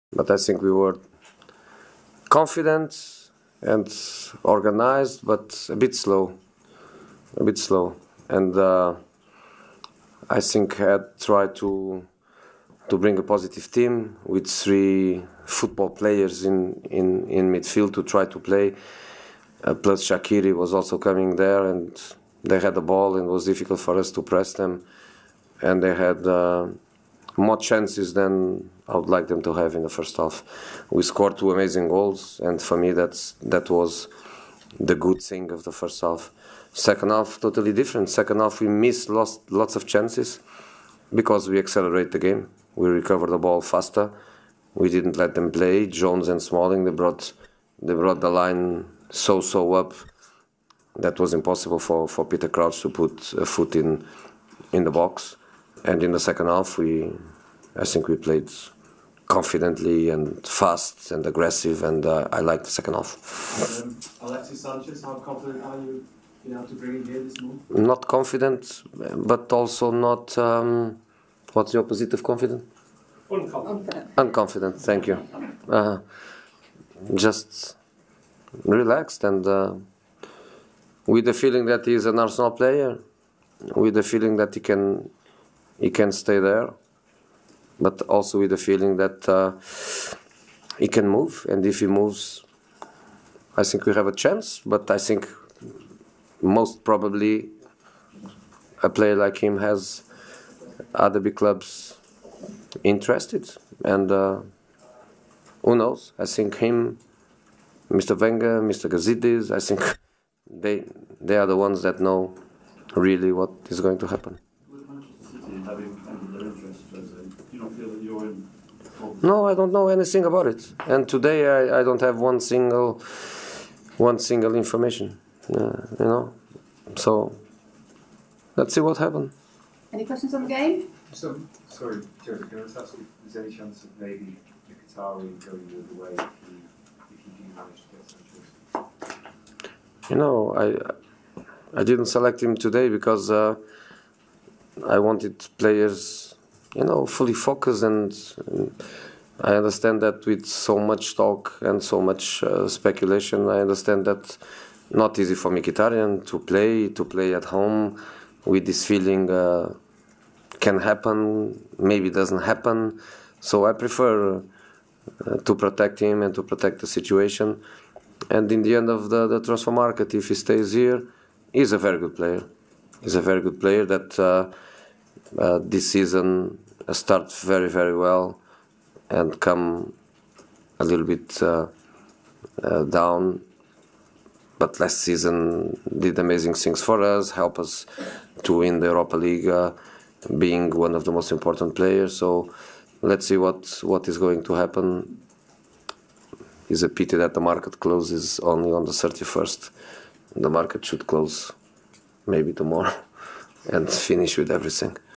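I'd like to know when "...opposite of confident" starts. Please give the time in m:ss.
1:11.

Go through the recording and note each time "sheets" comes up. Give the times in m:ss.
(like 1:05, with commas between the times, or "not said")
not said.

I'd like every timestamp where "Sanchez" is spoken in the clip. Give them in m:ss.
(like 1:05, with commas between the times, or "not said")
1:04, 2:19.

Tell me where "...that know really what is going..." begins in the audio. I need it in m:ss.
1:51.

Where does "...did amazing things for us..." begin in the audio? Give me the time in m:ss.
3:05.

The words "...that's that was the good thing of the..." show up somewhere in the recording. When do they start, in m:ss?
0:32.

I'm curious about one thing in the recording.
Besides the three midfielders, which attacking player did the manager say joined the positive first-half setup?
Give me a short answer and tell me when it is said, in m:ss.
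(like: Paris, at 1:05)
Shaqiri, at 0:20.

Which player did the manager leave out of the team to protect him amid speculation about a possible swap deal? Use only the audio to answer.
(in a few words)
Mkhitaryan.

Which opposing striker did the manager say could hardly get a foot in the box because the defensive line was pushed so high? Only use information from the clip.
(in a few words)
Peter Crouch.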